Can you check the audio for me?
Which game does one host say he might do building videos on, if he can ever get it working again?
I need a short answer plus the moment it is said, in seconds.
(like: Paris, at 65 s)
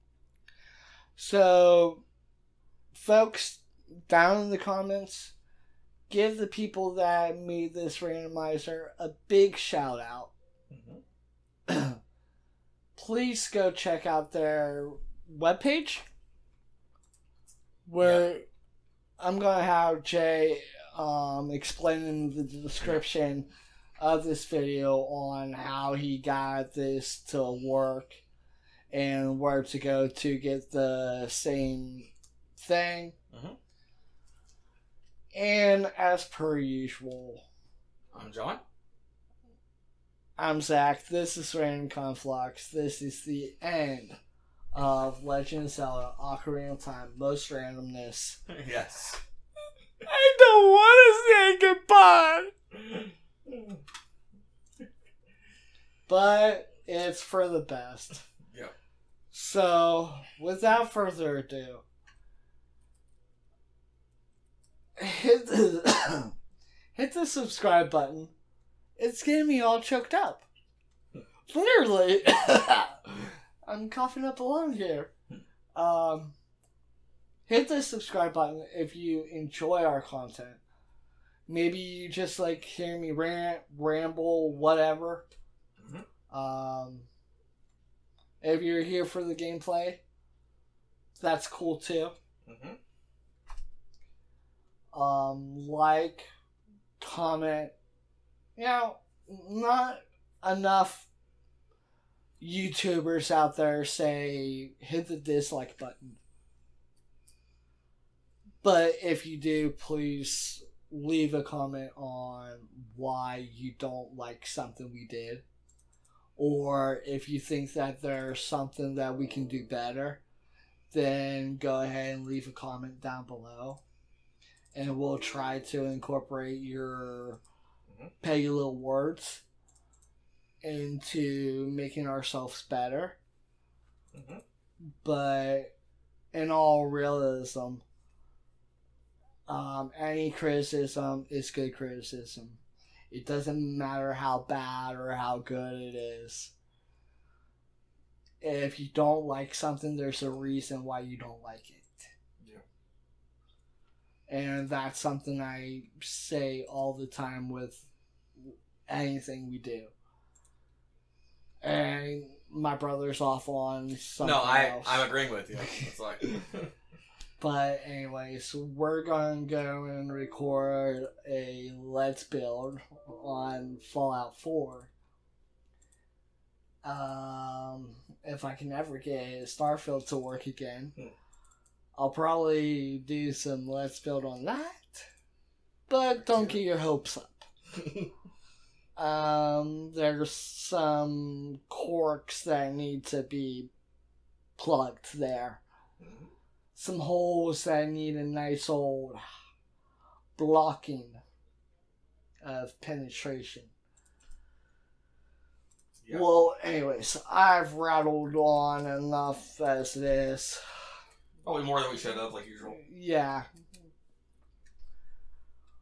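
Starfield, at 179 s.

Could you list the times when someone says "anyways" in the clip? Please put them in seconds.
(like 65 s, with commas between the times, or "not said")
167 s, 206 s.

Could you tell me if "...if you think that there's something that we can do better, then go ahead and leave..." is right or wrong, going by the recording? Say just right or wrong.
right.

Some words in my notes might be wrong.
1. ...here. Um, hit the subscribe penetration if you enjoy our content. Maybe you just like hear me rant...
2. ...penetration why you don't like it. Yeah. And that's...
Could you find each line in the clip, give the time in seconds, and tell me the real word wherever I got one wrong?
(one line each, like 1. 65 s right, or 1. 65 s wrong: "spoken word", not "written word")
1. 74 s wrong: "button", not "penetration"
2. 150 s wrong: "reason", not "penetration".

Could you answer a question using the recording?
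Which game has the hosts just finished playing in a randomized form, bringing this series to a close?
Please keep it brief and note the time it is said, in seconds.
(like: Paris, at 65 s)
Legend of Zelda: Ocarina of Time, at 45 s.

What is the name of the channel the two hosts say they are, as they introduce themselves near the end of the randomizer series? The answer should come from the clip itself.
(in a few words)
Random Conflux.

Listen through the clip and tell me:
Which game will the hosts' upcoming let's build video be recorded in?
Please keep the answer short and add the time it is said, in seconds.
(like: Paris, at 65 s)
Fallout 4, at 173 s.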